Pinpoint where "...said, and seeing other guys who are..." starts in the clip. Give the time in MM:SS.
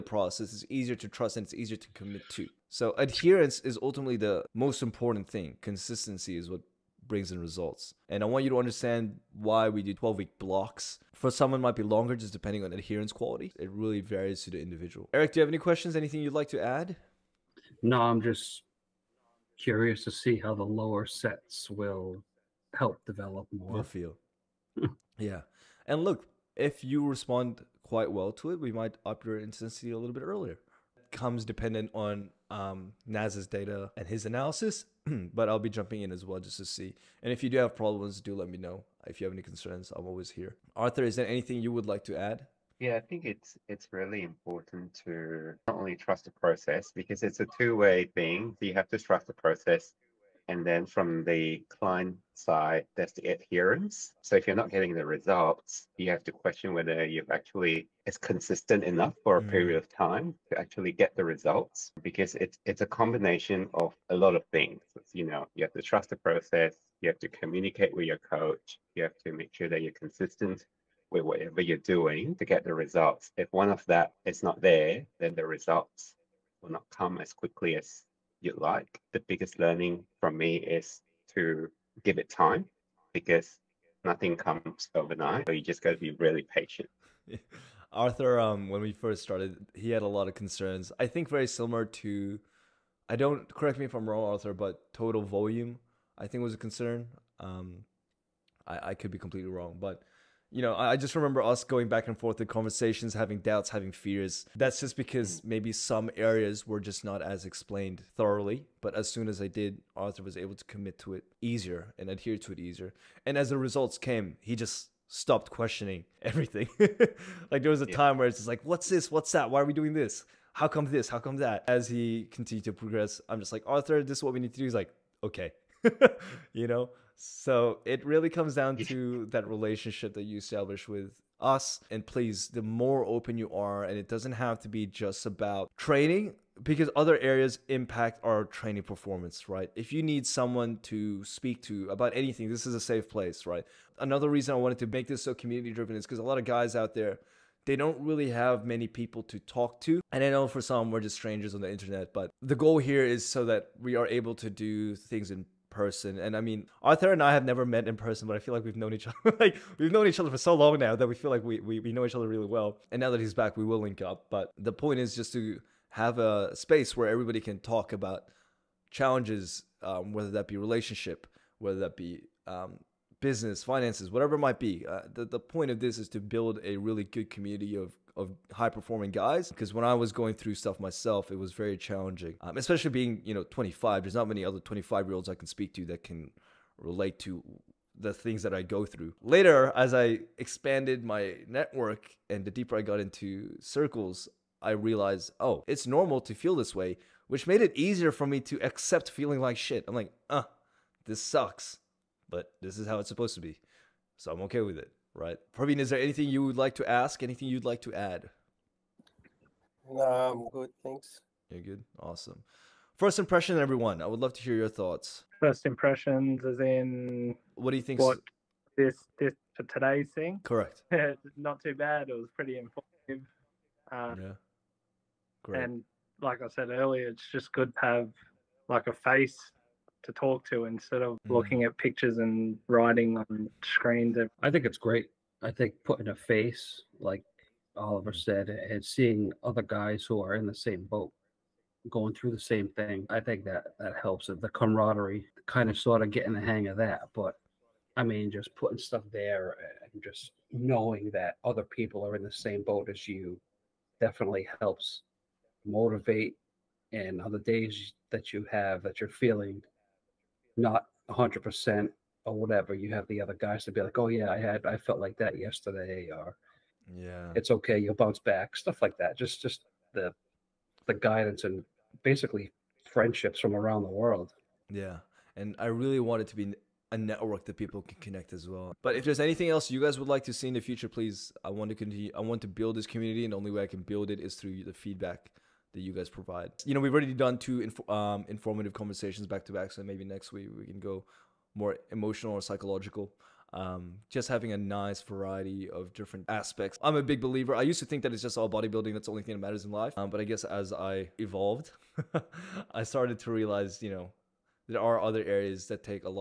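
03:58.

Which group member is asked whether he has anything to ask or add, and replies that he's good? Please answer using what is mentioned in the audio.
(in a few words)
Praveen.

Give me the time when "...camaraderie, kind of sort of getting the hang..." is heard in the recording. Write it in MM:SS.
04:04.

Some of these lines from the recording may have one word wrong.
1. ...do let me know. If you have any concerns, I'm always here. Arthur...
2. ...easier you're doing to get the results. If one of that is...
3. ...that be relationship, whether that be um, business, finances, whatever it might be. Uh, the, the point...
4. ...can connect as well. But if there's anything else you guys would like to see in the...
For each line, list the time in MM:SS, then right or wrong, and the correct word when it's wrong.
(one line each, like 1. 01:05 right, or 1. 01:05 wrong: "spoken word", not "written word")
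1. 00:38 right
2. 01:11 wrong: "whatever", not "easier"
3. 02:50 right
4. 04:37 right.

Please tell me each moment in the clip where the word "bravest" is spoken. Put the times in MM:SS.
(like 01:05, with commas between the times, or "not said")
not said.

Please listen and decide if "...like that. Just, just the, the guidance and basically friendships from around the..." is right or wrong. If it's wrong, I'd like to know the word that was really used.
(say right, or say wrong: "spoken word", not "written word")
right.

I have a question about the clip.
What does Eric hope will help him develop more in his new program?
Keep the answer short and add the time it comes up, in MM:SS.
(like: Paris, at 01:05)
lower sets, at 00:20.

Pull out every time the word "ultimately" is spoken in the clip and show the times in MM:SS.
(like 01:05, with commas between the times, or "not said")
00:03.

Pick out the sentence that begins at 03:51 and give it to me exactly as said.
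looking at pictures and writing on screens.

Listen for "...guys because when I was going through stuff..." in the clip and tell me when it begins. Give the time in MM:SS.
02:59.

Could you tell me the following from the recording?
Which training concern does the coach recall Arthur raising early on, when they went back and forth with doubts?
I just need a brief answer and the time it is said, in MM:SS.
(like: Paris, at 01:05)
total volume, at 01:34.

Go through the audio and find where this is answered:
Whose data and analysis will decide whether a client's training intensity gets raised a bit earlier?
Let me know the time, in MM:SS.
00:33.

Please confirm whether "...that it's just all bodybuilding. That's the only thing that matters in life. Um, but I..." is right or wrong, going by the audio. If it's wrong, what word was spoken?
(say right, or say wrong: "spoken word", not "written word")
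right.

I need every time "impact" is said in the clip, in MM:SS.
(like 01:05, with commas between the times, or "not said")
02:17.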